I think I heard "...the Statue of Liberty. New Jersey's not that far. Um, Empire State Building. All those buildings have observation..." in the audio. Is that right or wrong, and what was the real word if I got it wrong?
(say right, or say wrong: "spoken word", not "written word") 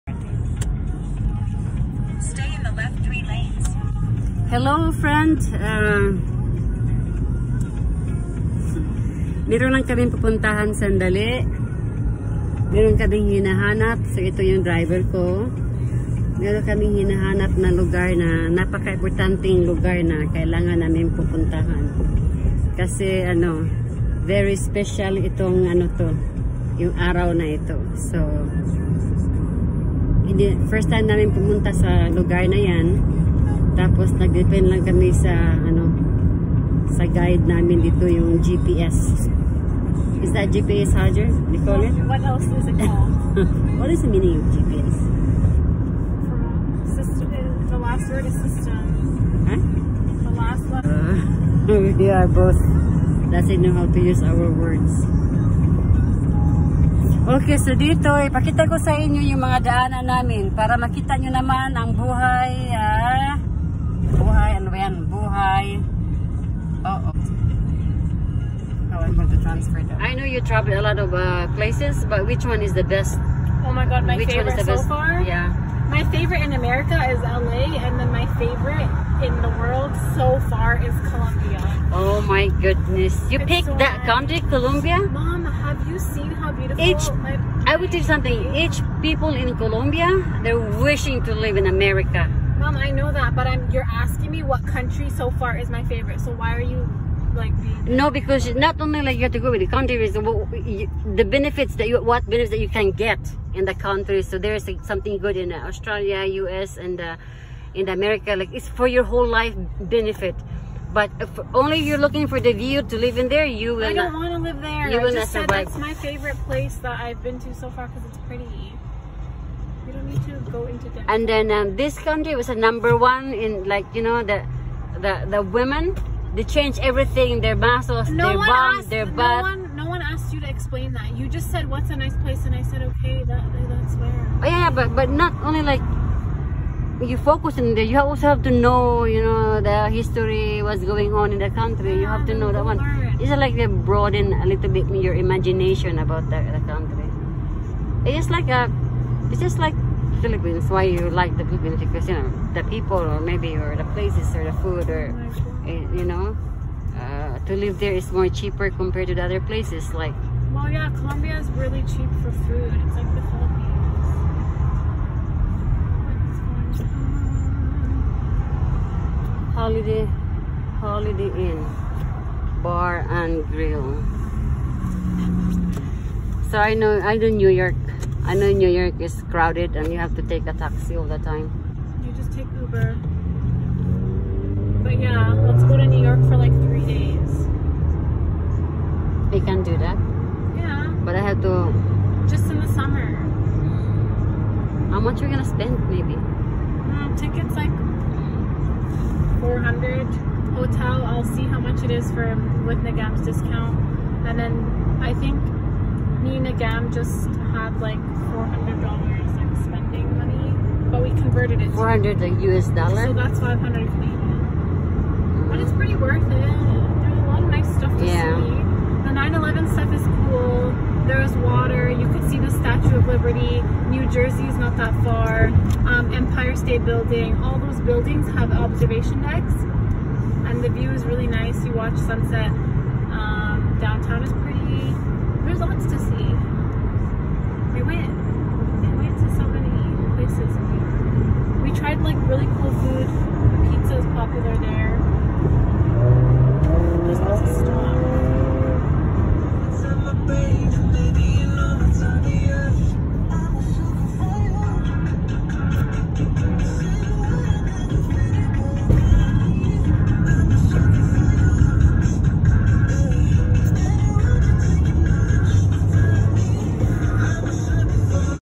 right.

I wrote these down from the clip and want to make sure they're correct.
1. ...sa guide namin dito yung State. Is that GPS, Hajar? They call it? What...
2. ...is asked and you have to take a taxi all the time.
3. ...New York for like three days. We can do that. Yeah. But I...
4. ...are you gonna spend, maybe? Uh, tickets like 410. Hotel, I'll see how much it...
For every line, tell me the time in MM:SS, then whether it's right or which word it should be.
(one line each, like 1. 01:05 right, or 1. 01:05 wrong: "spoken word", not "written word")
1. 00:36 wrong: "GPS", not "State"
2. 02:59 wrong: "crowded", not "asked"
3. 03:05 right
4. 03:15 wrong: "400", not "410".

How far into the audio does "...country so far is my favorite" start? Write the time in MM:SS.
01:34.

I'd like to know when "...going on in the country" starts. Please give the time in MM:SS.
02:20.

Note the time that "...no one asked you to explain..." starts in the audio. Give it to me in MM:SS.
02:09.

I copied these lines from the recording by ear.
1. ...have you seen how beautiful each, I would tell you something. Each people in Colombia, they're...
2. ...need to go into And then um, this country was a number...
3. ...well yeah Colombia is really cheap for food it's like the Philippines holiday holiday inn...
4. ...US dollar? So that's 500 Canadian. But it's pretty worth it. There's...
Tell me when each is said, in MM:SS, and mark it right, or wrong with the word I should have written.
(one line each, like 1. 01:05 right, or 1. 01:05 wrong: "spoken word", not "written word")
1. 01:25 right
2. 02:00 right
3. 02:40 right
4. 03:32 right.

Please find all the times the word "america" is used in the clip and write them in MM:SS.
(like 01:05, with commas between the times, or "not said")
01:16, 01:31, 01:47.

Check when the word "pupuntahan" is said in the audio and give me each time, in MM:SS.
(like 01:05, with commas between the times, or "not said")
00:10, 00:21.